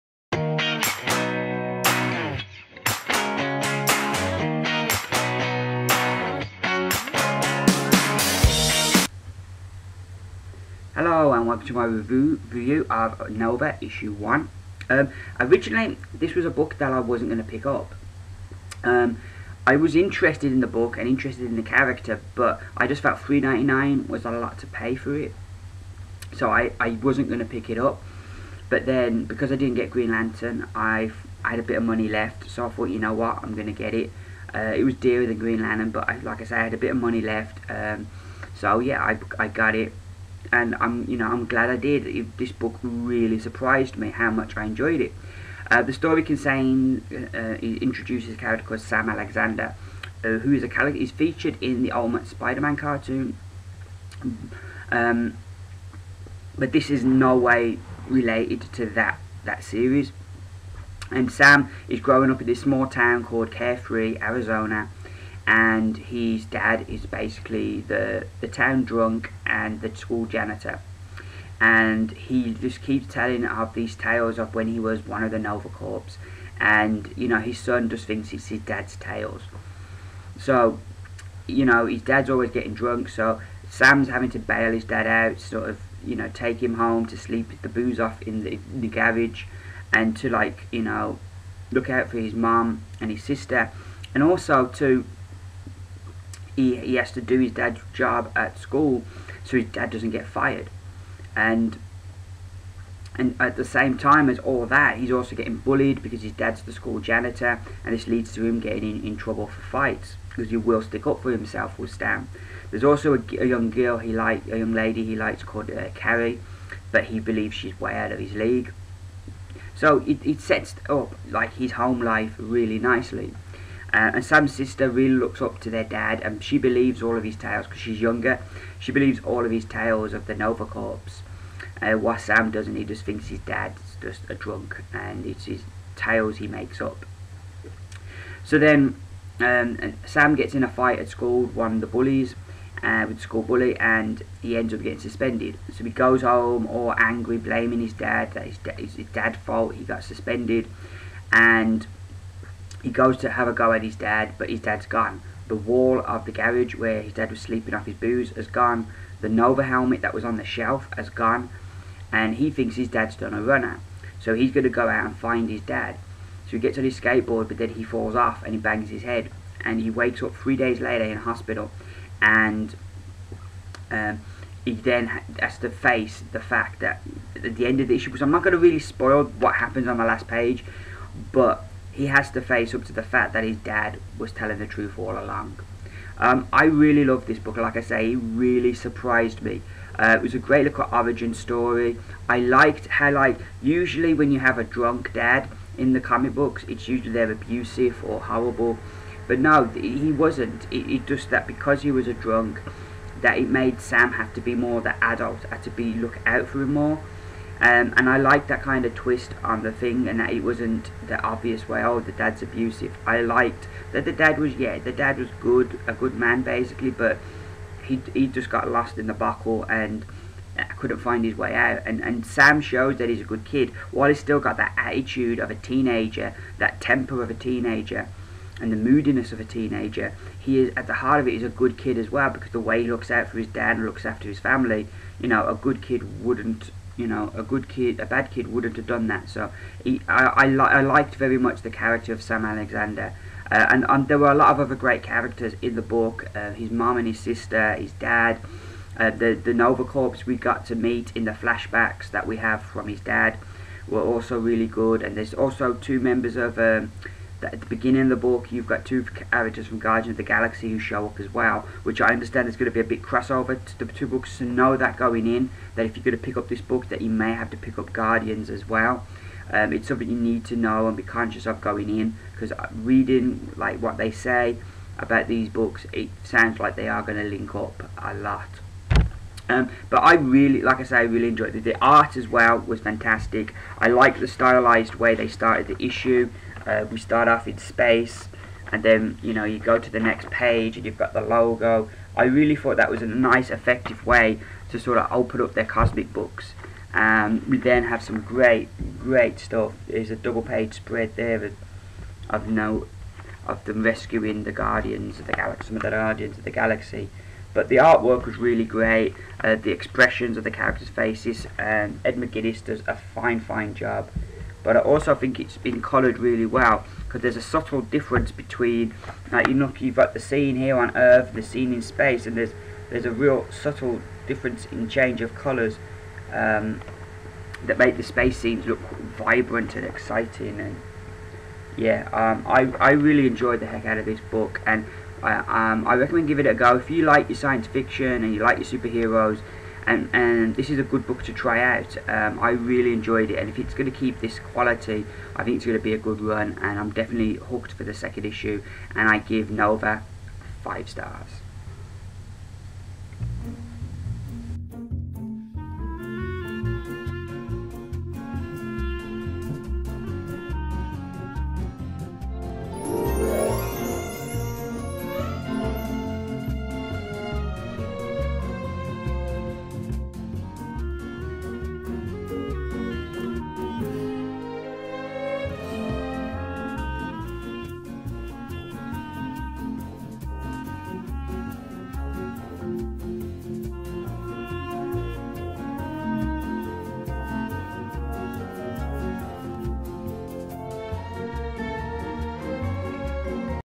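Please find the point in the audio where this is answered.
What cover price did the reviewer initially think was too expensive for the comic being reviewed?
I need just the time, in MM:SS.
00:23.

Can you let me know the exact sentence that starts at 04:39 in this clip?
Um, but I really, like I say, I really enjoyed it.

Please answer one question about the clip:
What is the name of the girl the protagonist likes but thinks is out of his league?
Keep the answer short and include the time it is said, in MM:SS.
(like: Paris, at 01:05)
Carrie, at 01:55.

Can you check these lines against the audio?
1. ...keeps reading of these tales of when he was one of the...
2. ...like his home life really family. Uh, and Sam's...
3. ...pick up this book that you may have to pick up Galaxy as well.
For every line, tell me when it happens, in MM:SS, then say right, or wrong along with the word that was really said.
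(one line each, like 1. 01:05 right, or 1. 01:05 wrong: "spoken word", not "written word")
1. 01:12 wrong: "telling", not "reading"
2. 02:01 wrong: "nicely", not "family"
3. 04:26 wrong: "Guardians", not "Galaxy".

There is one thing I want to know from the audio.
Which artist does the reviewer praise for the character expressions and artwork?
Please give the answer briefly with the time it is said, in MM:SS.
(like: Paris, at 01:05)
Ed McGuinness, at 05:12.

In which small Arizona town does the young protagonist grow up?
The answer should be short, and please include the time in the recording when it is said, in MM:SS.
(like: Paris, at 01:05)
Carefree, at 01:03.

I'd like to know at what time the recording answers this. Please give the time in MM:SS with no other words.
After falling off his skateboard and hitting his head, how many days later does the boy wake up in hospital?
02:50.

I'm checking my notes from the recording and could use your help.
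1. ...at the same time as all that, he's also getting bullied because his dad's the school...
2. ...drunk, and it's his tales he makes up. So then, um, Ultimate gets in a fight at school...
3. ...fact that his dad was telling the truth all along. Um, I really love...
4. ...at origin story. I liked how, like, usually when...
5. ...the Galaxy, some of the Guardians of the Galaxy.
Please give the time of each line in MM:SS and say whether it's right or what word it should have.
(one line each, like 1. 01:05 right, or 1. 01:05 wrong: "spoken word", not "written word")
1. 01:43 right
2. 02:14 wrong: "Sam", not "Ultimate"
3. 03:03 right
4. 03:10 right
5. 05:05 right.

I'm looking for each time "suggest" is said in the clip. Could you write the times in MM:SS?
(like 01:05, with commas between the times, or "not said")
not said.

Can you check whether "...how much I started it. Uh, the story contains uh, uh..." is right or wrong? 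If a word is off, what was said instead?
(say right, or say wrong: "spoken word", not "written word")
wrong: "enjoyed", not "started".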